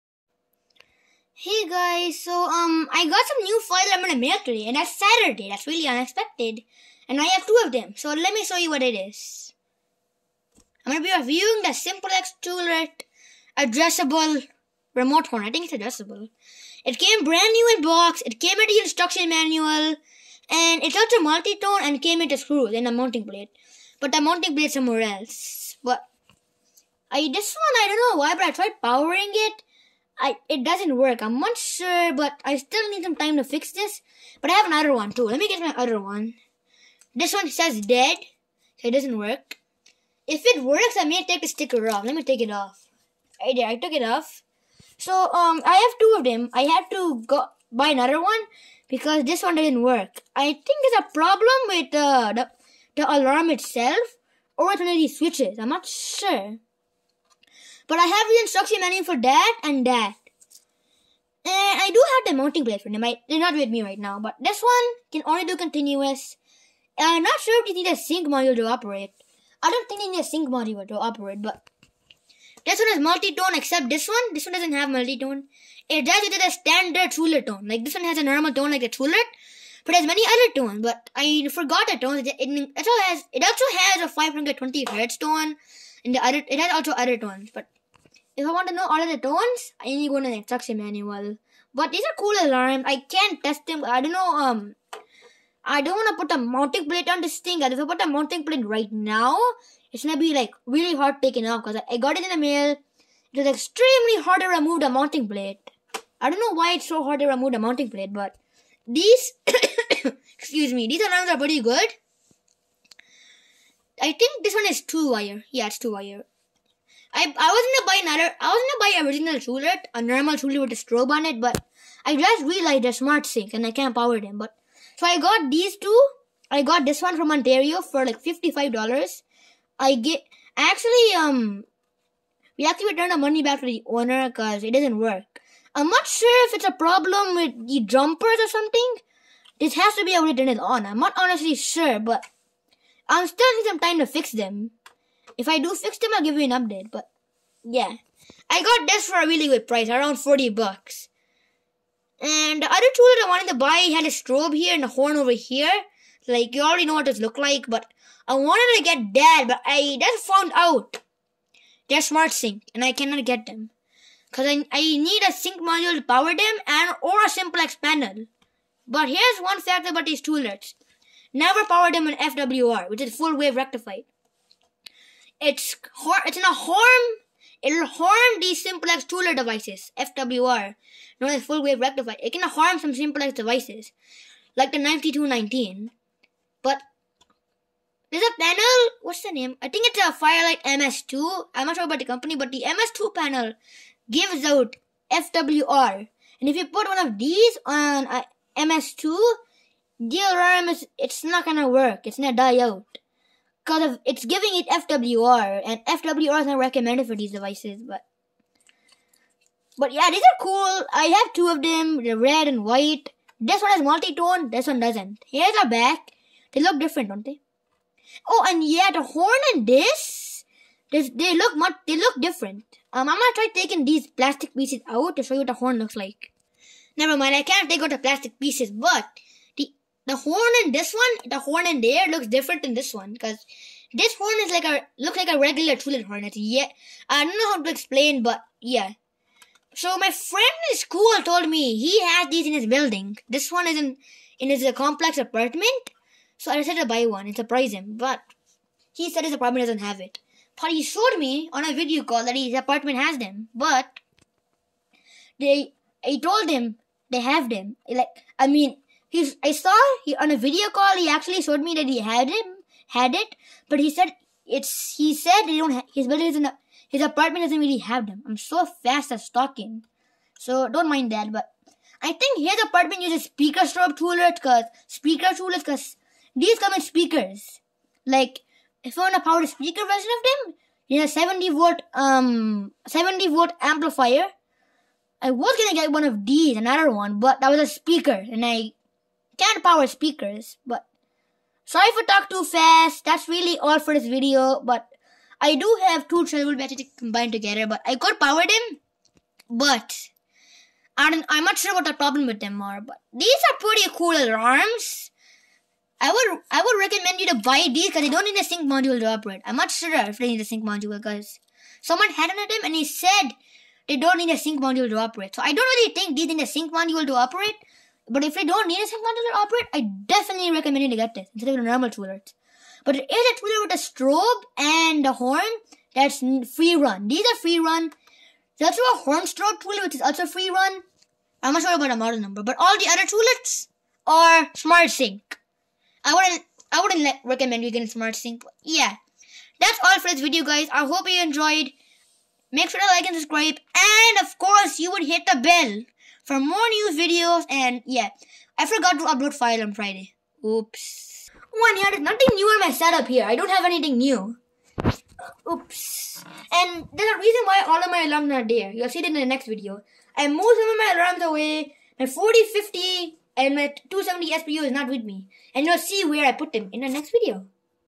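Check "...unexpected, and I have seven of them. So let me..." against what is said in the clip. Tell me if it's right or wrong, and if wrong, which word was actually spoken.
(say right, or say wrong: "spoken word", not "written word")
wrong: "two", not "seven".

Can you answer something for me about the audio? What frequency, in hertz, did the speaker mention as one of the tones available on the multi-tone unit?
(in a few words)
520.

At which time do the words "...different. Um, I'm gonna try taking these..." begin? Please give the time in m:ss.
3:42.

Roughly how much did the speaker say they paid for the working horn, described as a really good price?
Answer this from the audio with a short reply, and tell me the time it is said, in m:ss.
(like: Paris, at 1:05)
$40, at 2:29.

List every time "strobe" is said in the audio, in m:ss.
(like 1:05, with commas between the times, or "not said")
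2:00, 2:34, 4:33, 5:23, 5:29.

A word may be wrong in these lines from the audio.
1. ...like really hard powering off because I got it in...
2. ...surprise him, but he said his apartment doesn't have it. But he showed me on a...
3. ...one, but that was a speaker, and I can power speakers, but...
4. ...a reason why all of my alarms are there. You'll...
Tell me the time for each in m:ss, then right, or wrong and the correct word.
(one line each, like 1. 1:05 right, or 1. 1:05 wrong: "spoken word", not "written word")
1. 1:40 wrong: "taking", not "powering"
2. 4:07 right
3. 4:46 right
4. 5:57 right.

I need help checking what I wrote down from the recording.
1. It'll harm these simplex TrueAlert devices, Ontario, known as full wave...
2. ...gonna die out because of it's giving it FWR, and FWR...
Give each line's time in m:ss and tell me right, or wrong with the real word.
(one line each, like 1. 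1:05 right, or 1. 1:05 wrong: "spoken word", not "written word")
1. 2:57 wrong: "FWR", not "Ontario"
2. 3:22 right.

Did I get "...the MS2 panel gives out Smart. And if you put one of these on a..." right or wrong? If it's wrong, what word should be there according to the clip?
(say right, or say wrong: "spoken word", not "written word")
wrong: "FWR", not "Smart".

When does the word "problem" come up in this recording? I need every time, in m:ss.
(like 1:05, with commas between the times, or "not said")
0:51, 2:16, 5:01.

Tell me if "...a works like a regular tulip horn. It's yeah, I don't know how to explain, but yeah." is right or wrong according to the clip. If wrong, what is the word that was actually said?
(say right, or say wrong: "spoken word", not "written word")
wrong: "looks", not "works".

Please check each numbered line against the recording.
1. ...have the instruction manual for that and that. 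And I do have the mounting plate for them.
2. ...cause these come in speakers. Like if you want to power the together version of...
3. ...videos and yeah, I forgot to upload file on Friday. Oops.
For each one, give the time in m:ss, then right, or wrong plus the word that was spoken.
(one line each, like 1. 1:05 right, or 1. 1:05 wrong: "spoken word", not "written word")
1. 0:58 right
2. 4:35 wrong: "speaker", not "together"
3. 5:46 right.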